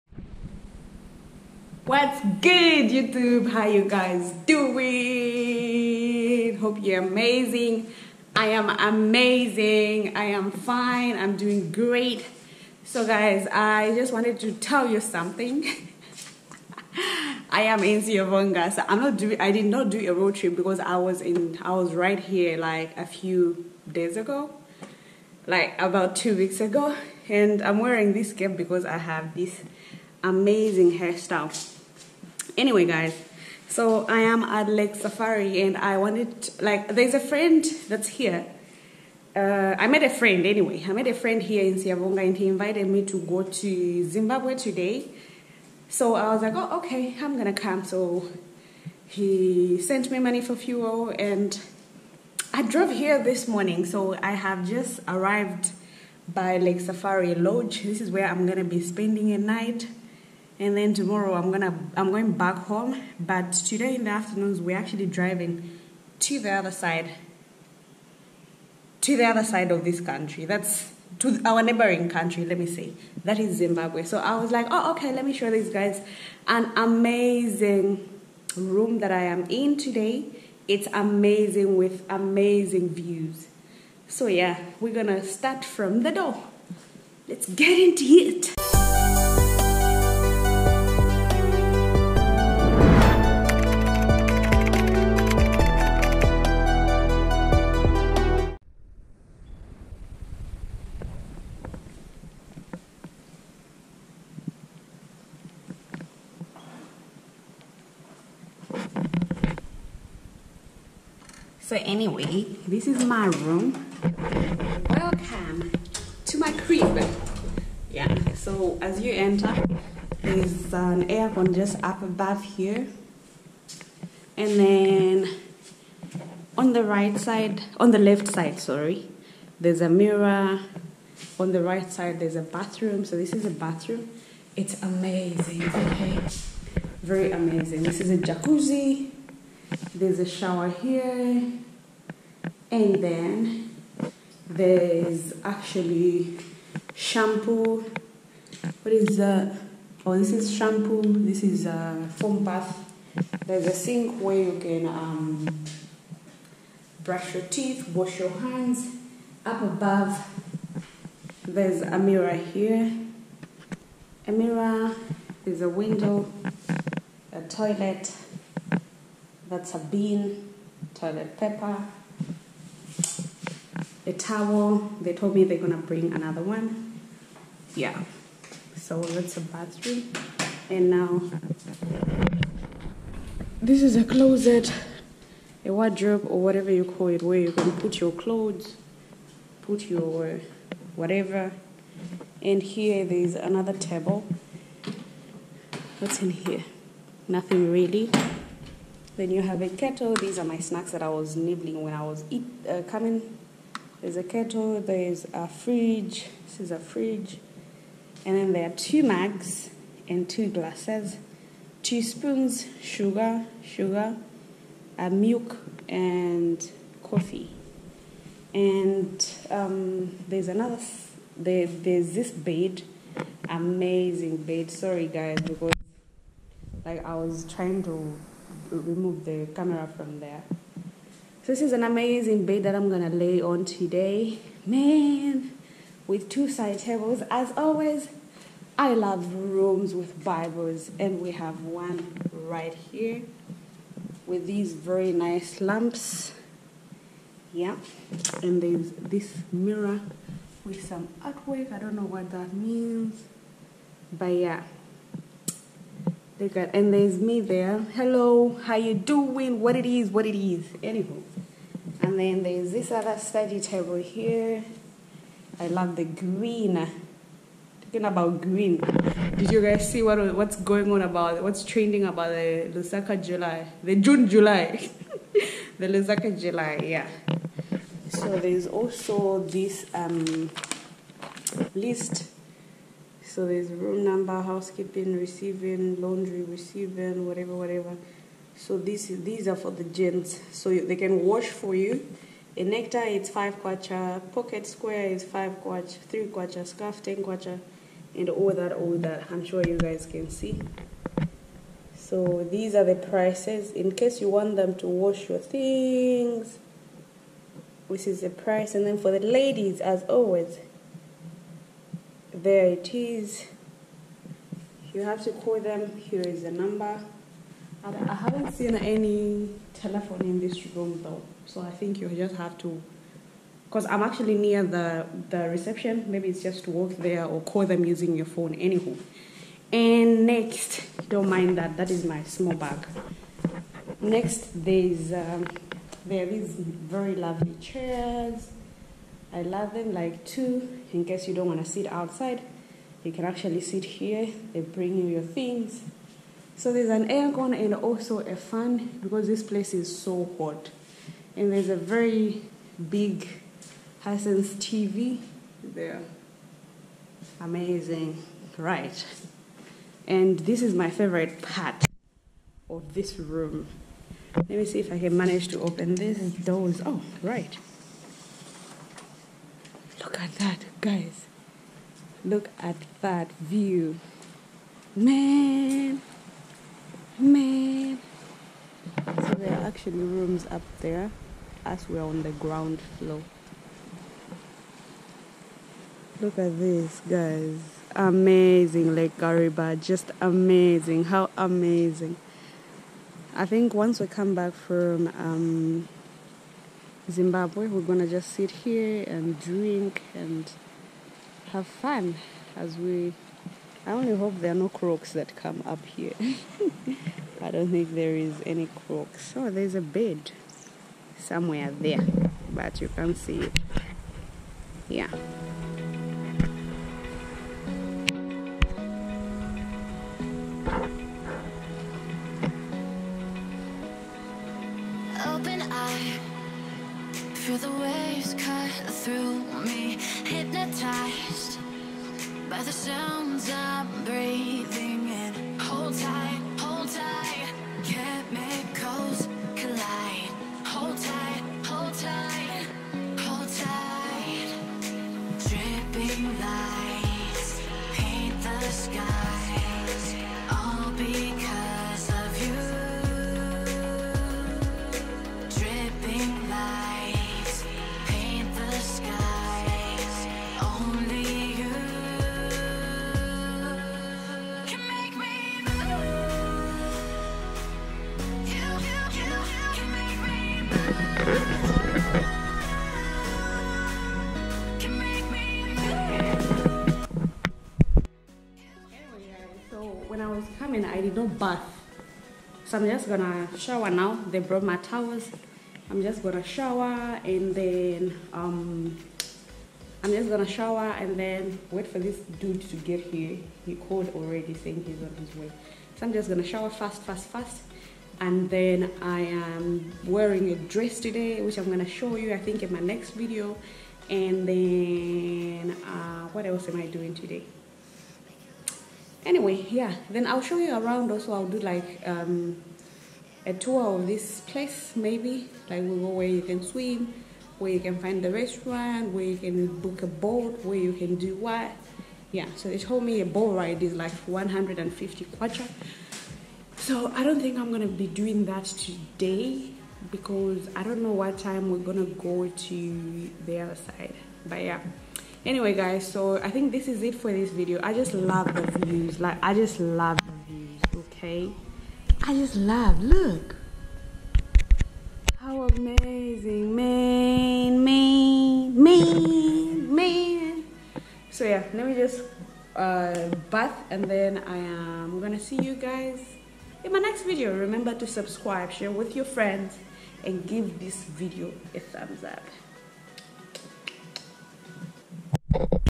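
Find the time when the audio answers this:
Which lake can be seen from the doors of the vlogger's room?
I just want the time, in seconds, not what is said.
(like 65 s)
388 s.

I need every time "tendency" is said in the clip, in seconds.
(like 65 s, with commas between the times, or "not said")
not said.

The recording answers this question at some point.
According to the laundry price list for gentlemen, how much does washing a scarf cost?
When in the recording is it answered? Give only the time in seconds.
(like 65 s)
297 s.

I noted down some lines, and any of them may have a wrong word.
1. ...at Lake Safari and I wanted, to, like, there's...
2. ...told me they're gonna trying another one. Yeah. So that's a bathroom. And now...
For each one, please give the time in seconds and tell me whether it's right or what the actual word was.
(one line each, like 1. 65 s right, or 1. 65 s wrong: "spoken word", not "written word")
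1. 34 s right
2. 175 s wrong: "bring", not "trying".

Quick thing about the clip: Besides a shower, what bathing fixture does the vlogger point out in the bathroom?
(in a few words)
Jacuzzi.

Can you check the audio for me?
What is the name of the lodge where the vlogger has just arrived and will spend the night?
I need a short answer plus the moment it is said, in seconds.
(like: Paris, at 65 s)
Lake Safari Lodge, at 56 s.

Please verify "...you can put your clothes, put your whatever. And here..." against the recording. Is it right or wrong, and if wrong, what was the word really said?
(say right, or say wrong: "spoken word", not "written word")
right.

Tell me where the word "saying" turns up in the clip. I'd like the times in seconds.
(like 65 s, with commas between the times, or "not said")
494 s.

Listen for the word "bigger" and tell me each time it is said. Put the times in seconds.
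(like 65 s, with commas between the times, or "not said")
not said.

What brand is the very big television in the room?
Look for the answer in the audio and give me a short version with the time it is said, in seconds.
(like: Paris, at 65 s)
Hisense, at 354 s.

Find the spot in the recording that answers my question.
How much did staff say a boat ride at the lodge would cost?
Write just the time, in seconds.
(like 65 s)
524 s.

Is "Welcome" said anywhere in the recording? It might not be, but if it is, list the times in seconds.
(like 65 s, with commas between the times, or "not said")
114 s.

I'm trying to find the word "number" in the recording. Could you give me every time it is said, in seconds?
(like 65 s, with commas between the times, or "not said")
284 s, 316 s.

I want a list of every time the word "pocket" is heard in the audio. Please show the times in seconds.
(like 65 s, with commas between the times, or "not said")
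294 s.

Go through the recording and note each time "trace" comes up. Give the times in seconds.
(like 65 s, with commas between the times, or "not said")
not said.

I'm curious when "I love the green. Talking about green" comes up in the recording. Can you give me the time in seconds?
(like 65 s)
265 s.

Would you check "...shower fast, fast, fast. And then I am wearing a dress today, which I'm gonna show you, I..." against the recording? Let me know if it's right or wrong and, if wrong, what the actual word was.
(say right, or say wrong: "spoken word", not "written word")
right.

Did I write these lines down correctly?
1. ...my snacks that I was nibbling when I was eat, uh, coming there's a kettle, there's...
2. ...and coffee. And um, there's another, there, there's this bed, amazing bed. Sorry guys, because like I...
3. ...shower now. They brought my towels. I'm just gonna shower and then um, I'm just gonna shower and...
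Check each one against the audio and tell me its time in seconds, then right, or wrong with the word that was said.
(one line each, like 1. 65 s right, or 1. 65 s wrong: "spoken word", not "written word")
1. 200 s right
2. 215 s right
3. 483 s right.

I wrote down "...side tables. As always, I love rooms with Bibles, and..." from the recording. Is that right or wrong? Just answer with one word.
right.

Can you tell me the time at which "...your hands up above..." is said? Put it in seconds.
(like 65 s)
158 s.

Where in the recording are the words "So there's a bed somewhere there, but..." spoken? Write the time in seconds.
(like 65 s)
409 s.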